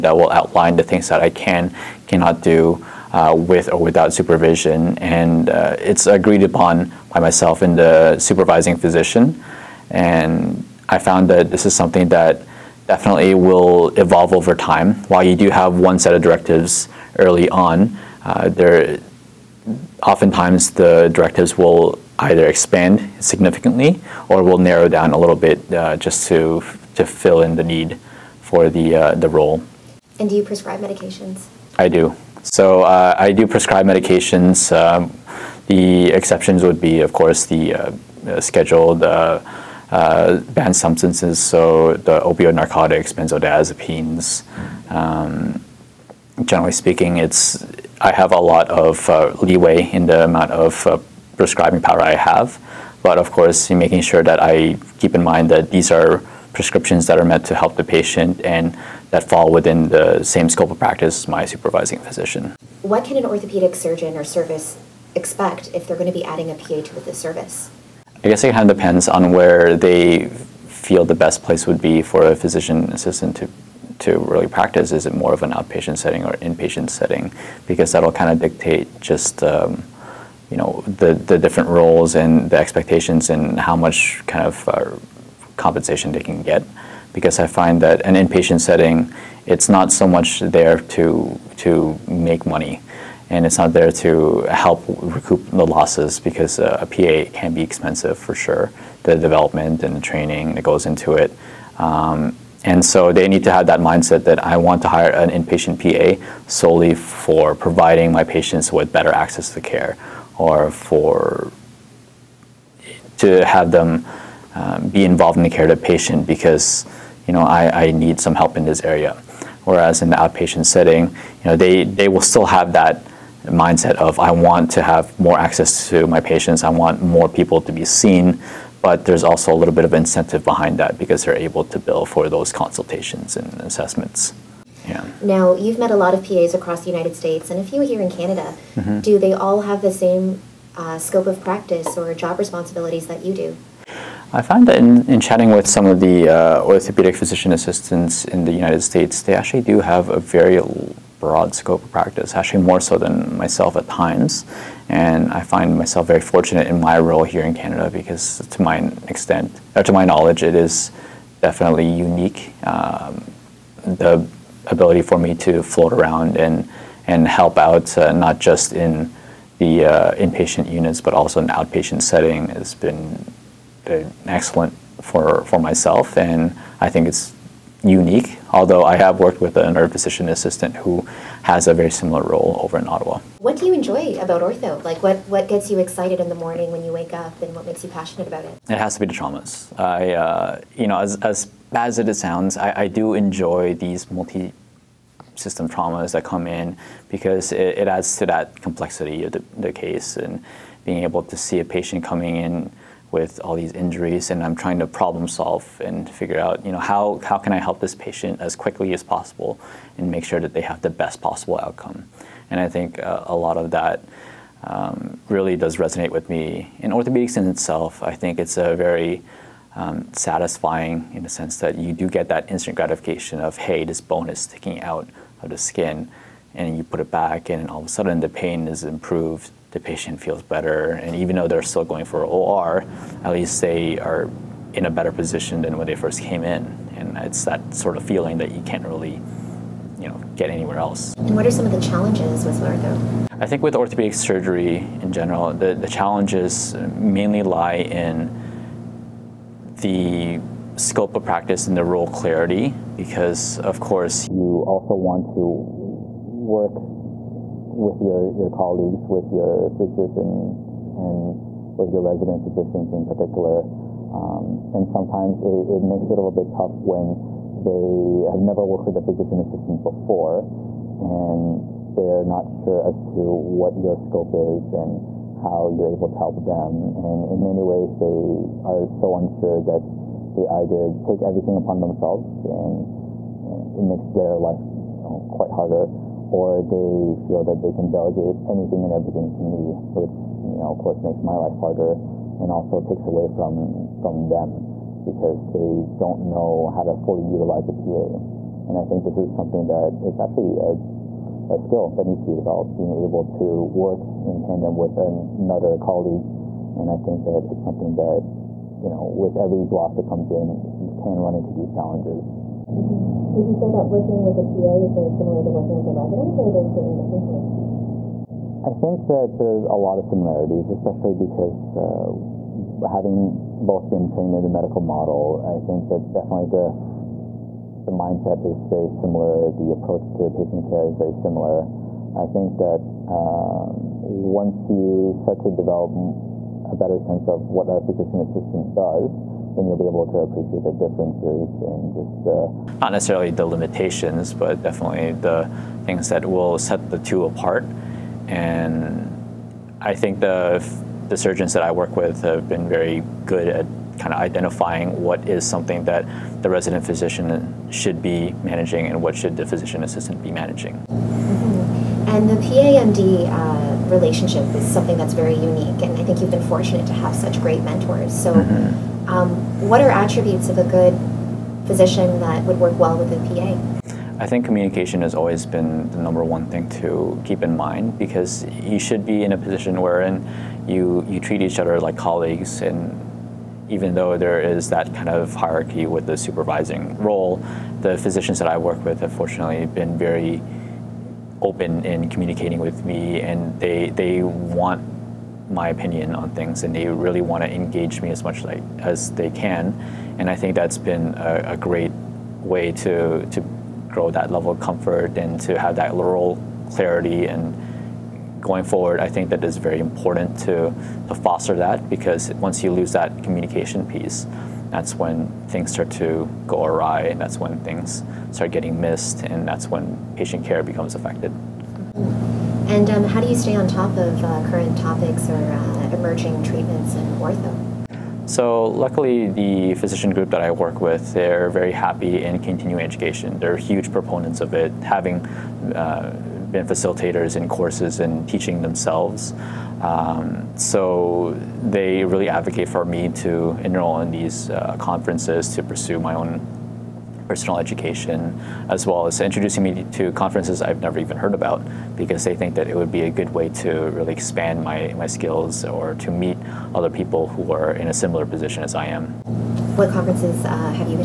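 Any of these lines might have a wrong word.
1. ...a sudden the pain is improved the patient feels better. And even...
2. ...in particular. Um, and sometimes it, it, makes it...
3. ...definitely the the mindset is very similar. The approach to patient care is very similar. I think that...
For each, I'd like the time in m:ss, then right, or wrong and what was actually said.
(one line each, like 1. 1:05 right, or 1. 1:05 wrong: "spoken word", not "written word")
1. 3:47 right
2. 4:22 right
3. 5:26 right.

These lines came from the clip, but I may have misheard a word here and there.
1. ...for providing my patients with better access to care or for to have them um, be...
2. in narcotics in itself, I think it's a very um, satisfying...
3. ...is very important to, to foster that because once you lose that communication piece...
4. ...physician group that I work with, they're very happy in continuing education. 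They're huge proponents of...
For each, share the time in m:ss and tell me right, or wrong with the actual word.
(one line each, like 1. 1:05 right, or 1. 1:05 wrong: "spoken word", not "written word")
1. 1:46 right
2. 3:36 wrong: "orthopedics", not "narcotics"
3. 6:49 right
4. 7:09 right.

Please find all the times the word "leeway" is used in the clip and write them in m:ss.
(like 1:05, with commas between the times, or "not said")
0:49.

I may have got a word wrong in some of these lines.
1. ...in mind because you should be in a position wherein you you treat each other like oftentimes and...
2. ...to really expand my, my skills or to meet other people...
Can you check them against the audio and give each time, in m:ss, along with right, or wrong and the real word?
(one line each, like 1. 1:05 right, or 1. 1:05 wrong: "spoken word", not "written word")
1. 6:17 wrong: "colleagues", not "oftentimes"
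2. 7:33 right.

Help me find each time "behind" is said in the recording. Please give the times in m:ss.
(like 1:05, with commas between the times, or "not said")
2:10.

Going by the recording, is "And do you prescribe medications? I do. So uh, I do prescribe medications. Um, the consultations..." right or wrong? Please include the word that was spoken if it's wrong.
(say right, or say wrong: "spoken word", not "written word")
wrong: "exceptions", not "consultations".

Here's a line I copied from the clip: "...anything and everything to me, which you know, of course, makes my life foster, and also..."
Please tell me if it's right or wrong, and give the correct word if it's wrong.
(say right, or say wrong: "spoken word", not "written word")
wrong: "harder", not "foster".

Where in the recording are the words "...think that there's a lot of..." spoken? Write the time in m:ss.
5:18.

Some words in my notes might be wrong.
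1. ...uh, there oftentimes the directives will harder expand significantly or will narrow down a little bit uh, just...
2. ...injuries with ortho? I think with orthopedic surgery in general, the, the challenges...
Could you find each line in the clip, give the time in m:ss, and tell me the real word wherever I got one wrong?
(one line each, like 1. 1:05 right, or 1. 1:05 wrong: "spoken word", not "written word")
1. 0:18 wrong: "either", not "harder"
2. 4:01 wrong: "challenges", not "injuries".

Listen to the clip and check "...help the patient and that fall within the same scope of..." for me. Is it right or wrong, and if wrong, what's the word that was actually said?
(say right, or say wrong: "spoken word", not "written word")
right.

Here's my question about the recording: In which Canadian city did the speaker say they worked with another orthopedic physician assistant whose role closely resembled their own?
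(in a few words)
Ottawa.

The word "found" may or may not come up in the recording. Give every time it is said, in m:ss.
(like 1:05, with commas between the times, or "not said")
0:10, 2:24.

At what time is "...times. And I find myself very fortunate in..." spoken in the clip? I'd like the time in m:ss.
2:33.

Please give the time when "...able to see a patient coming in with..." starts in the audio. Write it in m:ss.
3:21.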